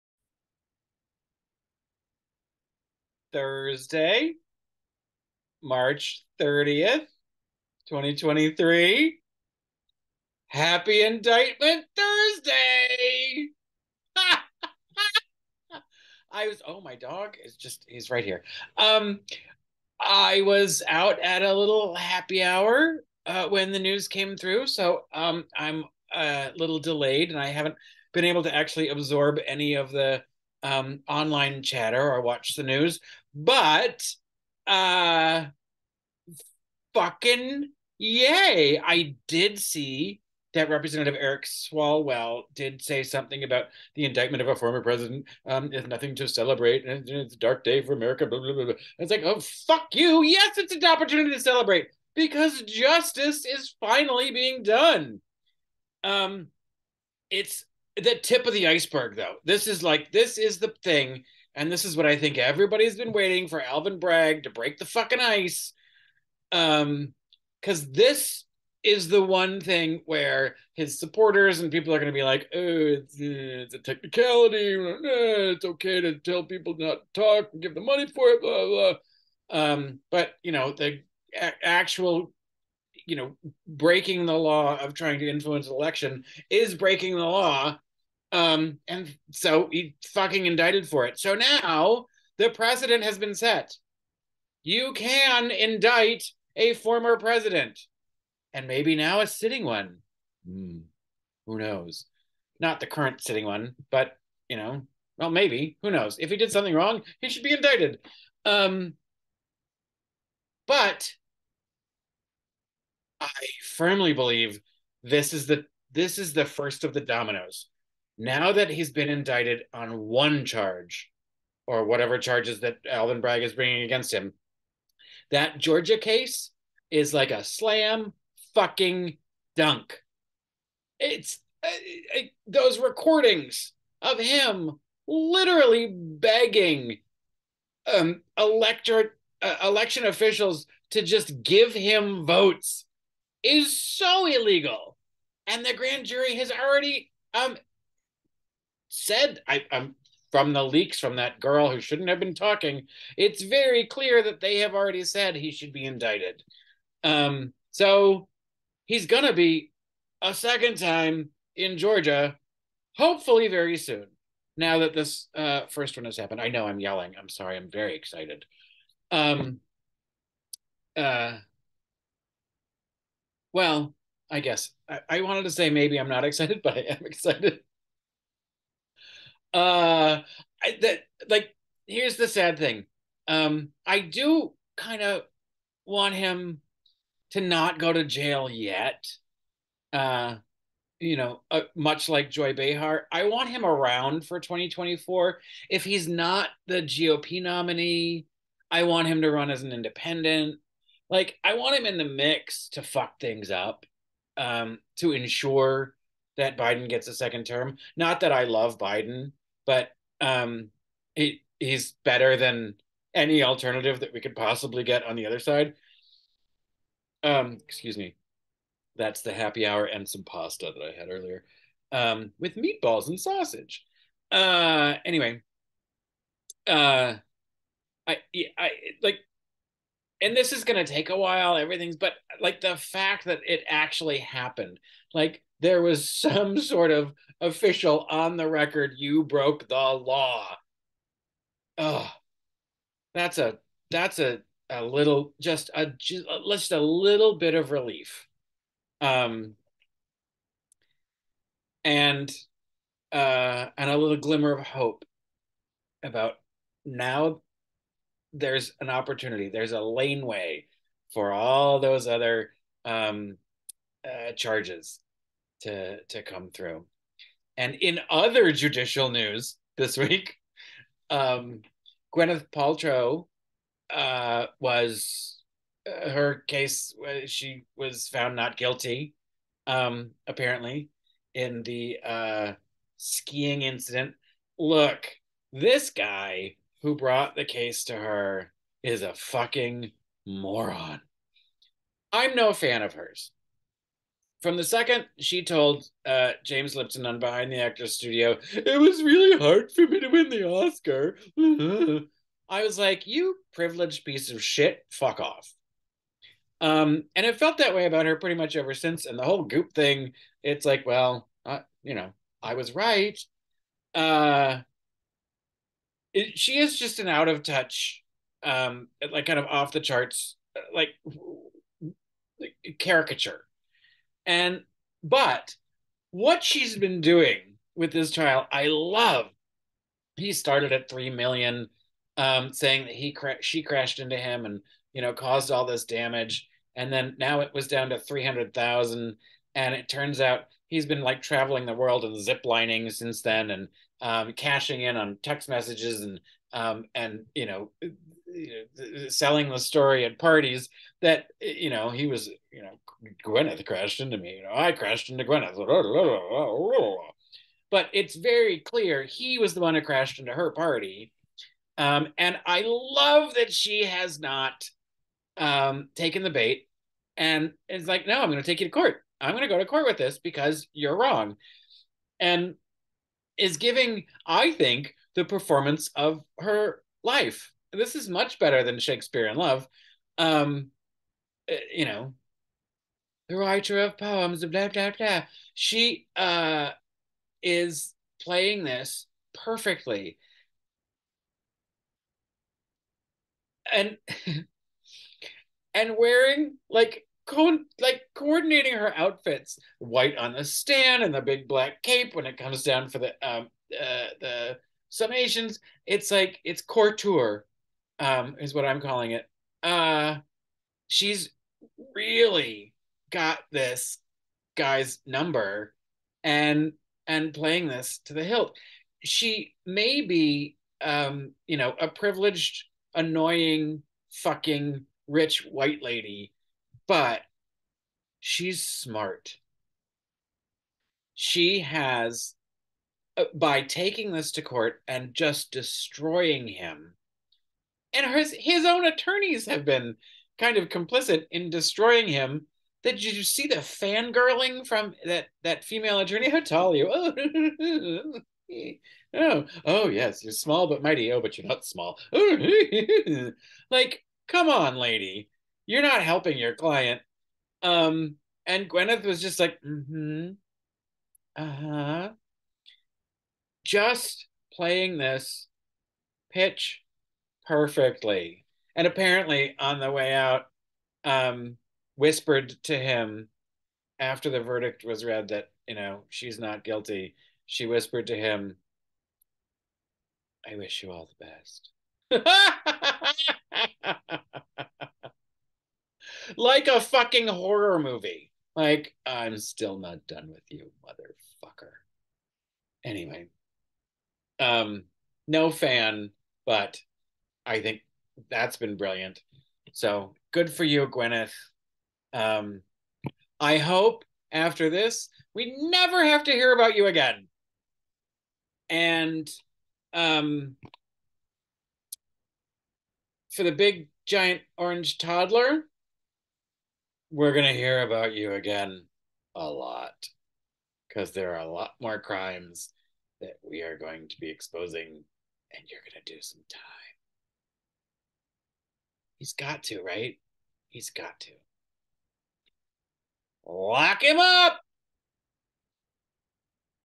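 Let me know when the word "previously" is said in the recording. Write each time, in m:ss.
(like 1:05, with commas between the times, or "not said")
not said.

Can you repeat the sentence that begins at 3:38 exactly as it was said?
That's the happy hour and some pasta that I had earlier.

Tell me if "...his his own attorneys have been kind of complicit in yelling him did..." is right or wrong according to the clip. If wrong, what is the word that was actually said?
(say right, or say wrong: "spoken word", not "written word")
wrong: "destroying", not "yelling".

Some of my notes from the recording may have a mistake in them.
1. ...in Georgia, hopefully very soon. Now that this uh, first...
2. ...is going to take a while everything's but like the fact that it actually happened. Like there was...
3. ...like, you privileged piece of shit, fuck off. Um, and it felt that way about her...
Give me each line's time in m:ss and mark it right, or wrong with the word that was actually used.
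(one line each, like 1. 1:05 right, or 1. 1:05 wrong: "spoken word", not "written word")
1. 2:41 right
2. 3:50 right
3. 5:02 right.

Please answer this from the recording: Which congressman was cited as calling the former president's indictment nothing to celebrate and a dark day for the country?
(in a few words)
Eric Swalwell.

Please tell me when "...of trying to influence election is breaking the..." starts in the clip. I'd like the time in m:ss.
1:24.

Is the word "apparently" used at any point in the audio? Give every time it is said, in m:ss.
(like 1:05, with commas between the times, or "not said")
4:40, 7:48.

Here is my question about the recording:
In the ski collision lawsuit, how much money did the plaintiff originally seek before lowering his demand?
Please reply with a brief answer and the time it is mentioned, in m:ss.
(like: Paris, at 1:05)
3 million, at 5:30.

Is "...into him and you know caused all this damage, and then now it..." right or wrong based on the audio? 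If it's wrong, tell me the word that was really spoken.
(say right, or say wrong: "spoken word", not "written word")
right.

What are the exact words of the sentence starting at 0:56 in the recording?
Um, it's the tip of the iceberg, though.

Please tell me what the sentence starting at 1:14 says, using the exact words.
Uh, it's okay to tell people not to talk and give the money for it, blah, blah.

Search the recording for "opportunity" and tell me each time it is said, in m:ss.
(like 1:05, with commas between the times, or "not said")
0:50, 4:18.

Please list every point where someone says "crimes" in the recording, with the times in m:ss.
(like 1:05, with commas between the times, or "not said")
8:41.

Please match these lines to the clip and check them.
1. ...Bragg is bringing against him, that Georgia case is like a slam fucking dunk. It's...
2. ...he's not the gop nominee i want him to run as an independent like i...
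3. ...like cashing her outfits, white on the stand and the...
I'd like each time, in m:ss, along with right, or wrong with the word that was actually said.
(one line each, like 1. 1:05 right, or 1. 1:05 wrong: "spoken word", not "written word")
1. 2:03 right
2. 3:15 right
3. 6:37 wrong: "coordinating", not "cashing".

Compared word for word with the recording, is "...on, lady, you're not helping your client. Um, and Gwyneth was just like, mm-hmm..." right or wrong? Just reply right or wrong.
right.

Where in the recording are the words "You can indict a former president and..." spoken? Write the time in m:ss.
1:34.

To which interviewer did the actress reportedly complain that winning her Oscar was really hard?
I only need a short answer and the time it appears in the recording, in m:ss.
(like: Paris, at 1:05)
James Lipton, at 4:56.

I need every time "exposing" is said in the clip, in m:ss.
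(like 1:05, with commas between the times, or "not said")
8:44.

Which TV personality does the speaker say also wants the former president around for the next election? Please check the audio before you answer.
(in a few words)
Joy Behar.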